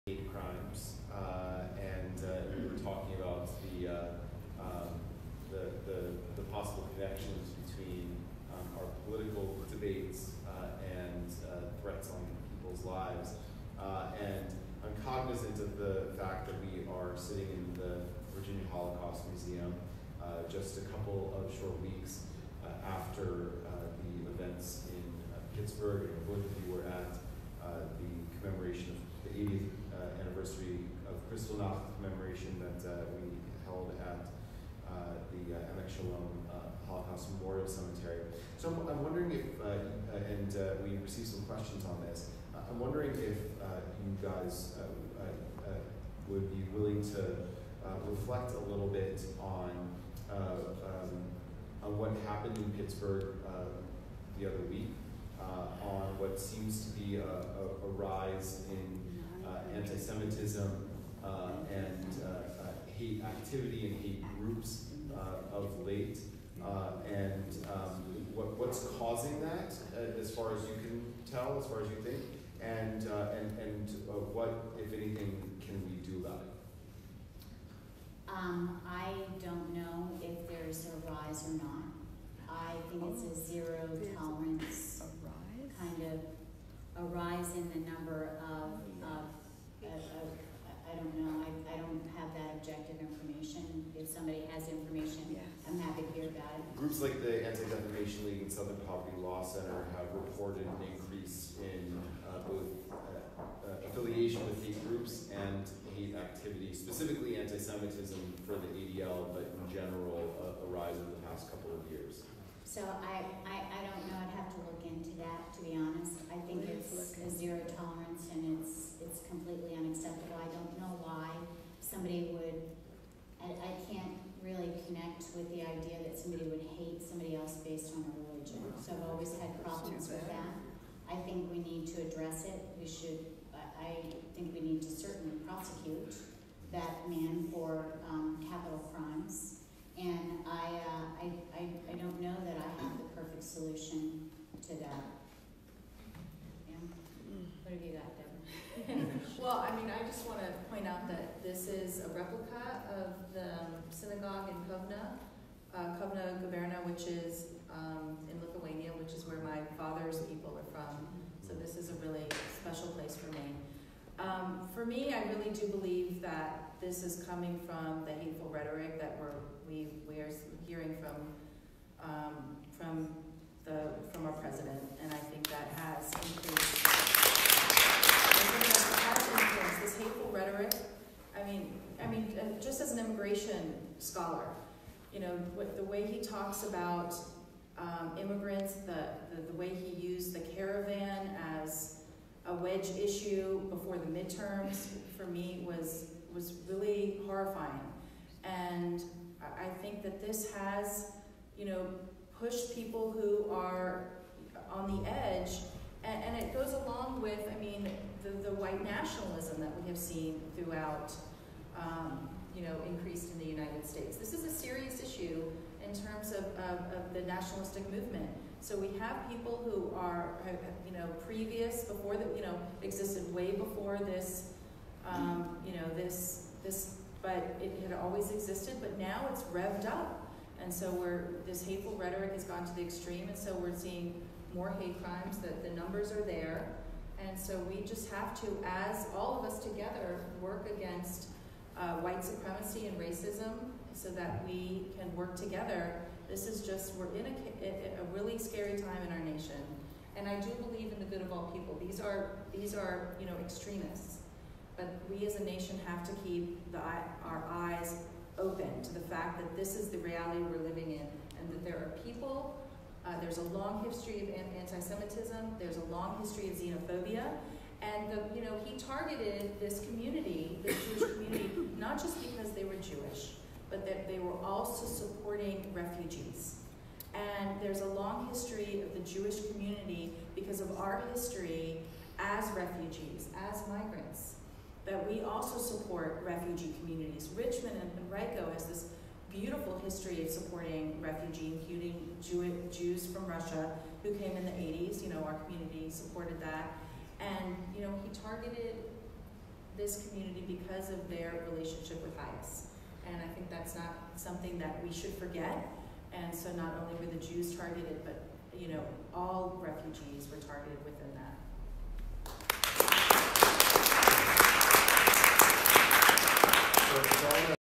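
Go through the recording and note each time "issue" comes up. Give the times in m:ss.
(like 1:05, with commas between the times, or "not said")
3:13, 3:35.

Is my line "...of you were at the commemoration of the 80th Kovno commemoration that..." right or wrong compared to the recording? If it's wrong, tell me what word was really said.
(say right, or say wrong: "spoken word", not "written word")
wrong: "Kristallnacht", not "Kovno".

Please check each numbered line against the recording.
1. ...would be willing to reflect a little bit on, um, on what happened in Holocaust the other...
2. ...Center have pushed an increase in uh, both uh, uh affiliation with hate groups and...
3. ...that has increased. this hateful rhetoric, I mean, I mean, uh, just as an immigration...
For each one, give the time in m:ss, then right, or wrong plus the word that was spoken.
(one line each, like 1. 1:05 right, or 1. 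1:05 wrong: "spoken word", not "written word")
1. 0:46 wrong: "Pittsburgh", not "Holocaust"
2. 1:39 wrong: "reported", not "pushed"
3. 2:55 right.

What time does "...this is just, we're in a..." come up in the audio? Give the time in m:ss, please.
4:06.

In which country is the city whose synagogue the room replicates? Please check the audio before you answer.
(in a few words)
Lithuania.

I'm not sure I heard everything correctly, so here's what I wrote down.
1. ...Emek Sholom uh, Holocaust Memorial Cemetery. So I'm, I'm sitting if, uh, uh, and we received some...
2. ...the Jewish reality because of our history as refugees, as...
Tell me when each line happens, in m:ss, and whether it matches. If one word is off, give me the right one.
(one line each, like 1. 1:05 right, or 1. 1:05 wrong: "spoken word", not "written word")
1. 0:35 wrong: "wondering", not "sitting"
2. 4:38 wrong: "community", not "reality".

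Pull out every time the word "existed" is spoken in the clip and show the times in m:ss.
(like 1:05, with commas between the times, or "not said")
3:42, 3:48.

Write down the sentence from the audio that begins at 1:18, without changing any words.
Um, I don't know if there's a rise or not.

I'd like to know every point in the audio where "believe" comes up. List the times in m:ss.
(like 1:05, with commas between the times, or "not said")
2:45, 4:10.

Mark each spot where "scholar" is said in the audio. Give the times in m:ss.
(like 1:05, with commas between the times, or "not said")
3:03.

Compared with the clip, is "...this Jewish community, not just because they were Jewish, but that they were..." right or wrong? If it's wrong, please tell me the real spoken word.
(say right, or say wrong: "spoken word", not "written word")
right.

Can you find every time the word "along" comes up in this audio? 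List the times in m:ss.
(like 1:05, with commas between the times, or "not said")
3:26.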